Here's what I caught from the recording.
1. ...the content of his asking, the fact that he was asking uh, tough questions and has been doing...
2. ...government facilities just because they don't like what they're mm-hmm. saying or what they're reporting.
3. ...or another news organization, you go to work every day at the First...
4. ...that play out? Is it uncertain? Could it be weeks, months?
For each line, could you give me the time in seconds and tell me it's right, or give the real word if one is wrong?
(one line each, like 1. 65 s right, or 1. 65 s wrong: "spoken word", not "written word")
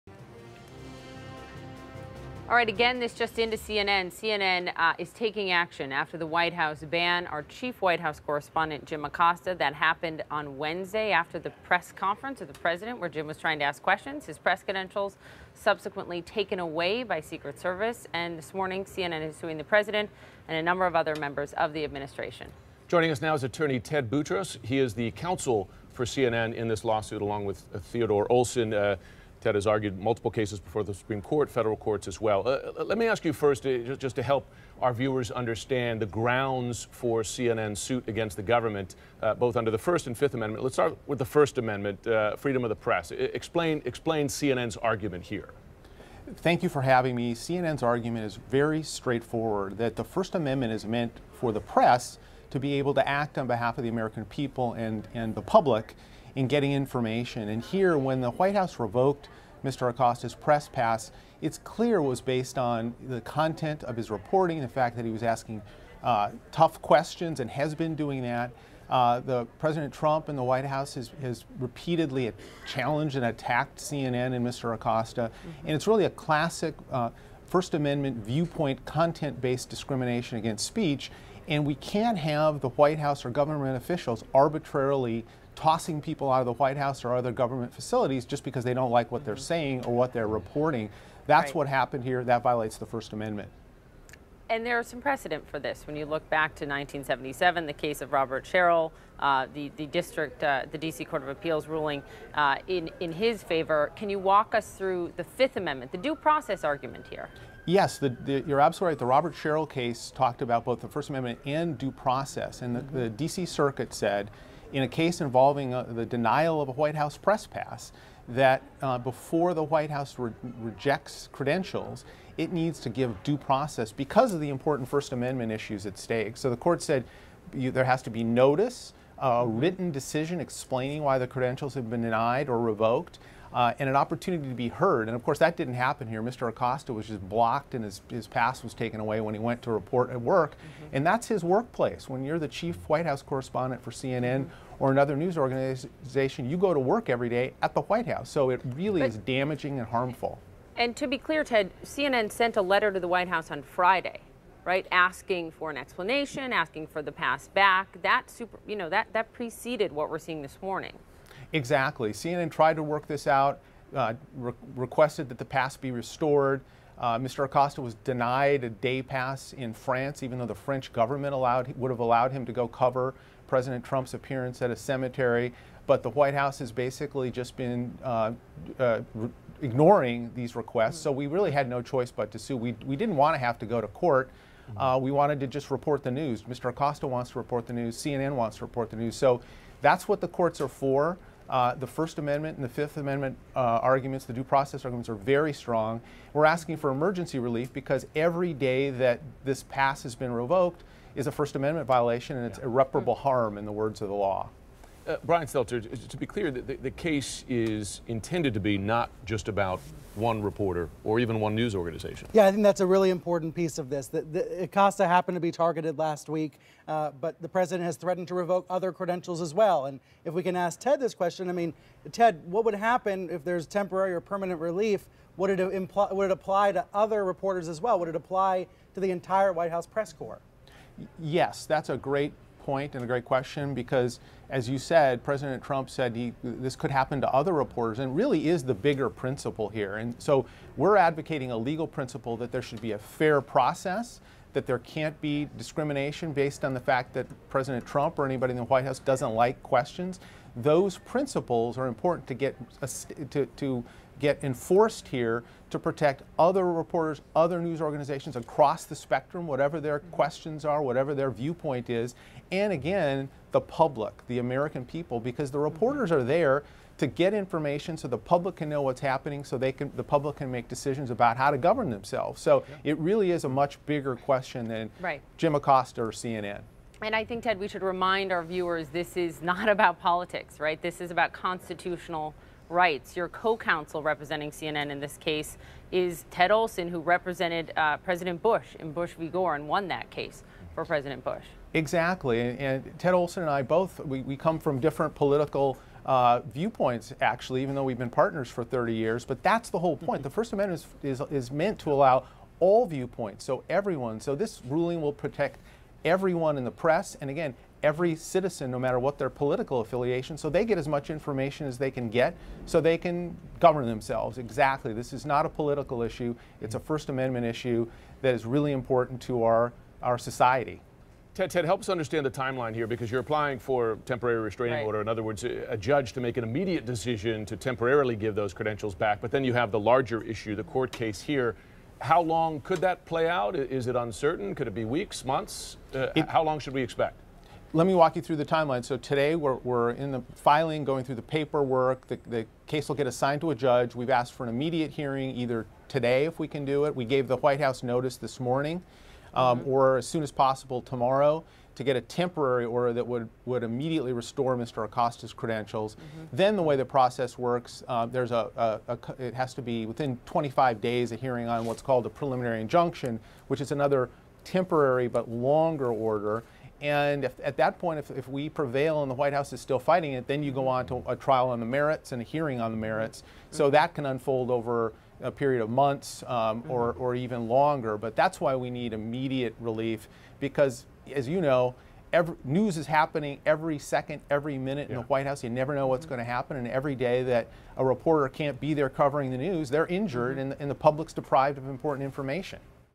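1. 63 s wrong: "reporting", not "asking"
2. 87 s right
3. 144 s wrong: "White", not "First"
4. 332 s right.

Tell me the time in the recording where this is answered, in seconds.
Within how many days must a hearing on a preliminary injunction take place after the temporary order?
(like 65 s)
360 s.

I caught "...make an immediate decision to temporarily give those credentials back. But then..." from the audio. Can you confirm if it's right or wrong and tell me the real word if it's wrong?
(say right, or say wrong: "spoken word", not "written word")
right.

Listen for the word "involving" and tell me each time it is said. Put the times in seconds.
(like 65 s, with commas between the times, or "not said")
115 s.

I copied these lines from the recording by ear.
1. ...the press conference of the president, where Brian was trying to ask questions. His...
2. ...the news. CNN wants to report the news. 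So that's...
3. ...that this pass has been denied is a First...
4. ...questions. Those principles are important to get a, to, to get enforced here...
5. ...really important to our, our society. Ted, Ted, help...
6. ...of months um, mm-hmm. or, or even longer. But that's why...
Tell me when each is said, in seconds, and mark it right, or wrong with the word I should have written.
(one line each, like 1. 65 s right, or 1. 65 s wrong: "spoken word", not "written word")
1. 11 s wrong: "Jim", not "Brian"
2. 187 s right
3. 198 s wrong: "revoked", not "denied"
4. 249 s right
5. 318 s right
6. 375 s right.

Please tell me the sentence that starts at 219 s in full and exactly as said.
And if we can ask Ted this question, I mean, Ted, what would happen if there's temporary or permanent relief?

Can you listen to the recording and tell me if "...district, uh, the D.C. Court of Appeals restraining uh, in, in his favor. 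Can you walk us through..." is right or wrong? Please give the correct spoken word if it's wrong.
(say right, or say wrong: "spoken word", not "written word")
wrong: "ruling", not "restraining".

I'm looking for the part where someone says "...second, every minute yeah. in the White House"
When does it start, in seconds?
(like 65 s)
383 s.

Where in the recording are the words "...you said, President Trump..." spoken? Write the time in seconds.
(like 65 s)
234 s.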